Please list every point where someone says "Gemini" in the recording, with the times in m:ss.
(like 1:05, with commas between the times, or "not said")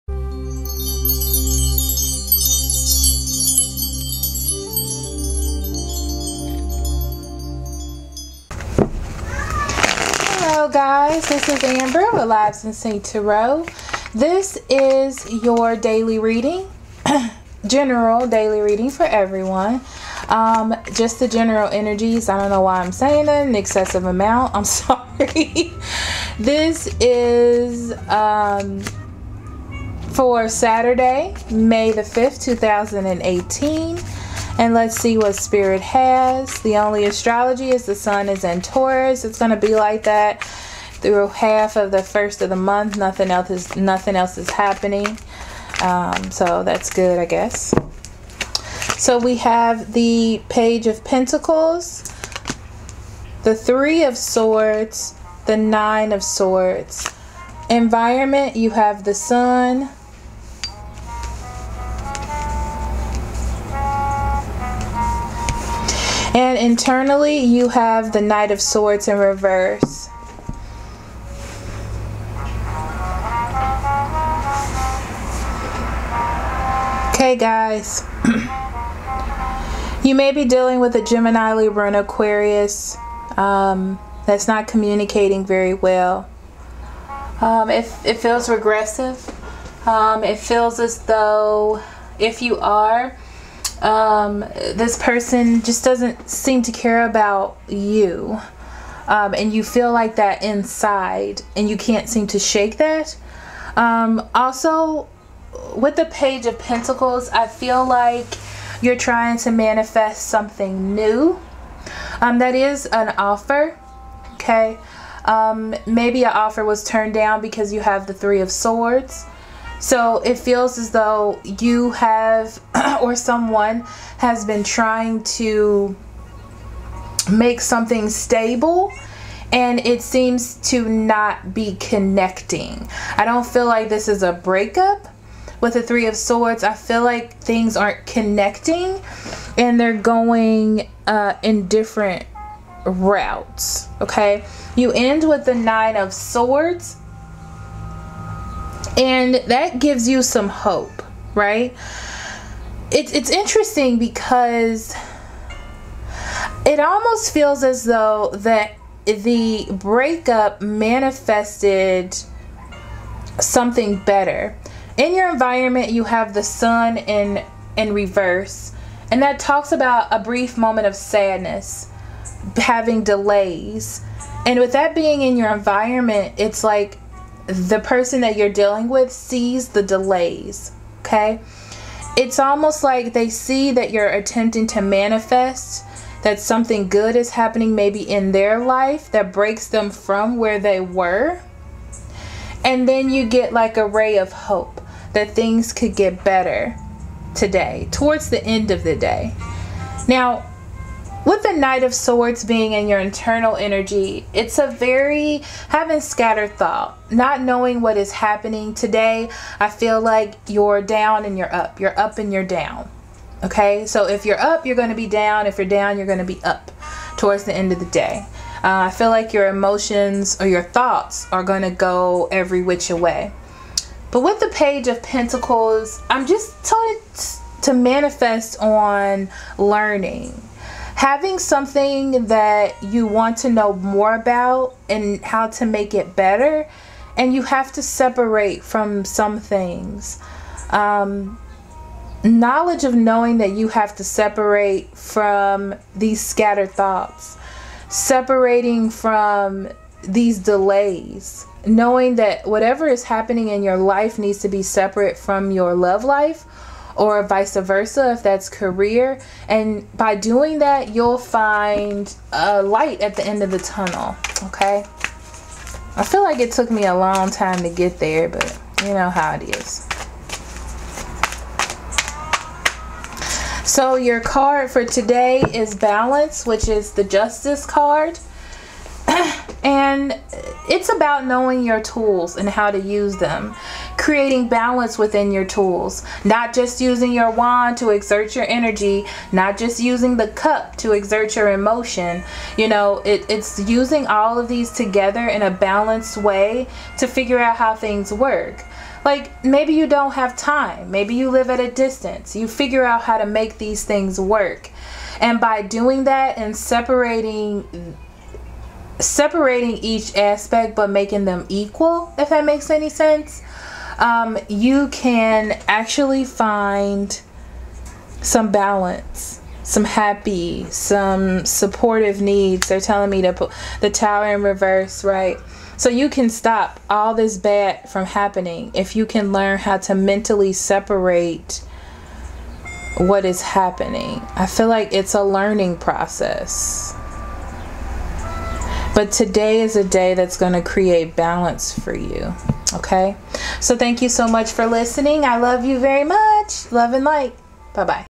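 1:21.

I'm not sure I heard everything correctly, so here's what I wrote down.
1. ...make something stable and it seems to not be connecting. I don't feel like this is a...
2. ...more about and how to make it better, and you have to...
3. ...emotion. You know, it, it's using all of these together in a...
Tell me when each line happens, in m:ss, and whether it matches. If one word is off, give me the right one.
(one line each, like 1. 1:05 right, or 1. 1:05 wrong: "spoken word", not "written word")
1. 2:07 right
2. 3:53 right
3. 4:51 right.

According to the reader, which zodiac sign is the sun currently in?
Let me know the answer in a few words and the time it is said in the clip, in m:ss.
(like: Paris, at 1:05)
Taurus, at 0:38.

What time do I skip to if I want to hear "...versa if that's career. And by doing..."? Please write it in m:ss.
4:17.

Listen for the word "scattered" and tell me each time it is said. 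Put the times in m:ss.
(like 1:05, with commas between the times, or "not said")
3:26, 4:06.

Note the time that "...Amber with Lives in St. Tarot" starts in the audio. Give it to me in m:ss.
0:11.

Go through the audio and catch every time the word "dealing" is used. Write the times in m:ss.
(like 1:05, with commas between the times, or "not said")
1:20, 2:58.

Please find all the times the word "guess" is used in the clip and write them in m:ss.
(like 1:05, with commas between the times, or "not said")
0:47.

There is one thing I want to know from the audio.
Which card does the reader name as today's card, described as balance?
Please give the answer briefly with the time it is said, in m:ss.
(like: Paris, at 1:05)
Justice, at 4:37.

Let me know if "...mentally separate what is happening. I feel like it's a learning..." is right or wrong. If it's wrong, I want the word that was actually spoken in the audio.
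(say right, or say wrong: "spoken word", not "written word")
right.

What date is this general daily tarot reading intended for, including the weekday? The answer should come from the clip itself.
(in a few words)
Saturday, May 5, 2018.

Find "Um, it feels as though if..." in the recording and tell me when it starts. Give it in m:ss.
1:29.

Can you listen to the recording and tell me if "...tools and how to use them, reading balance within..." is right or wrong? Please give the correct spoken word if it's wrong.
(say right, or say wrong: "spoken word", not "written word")
wrong: "creating", not "reading".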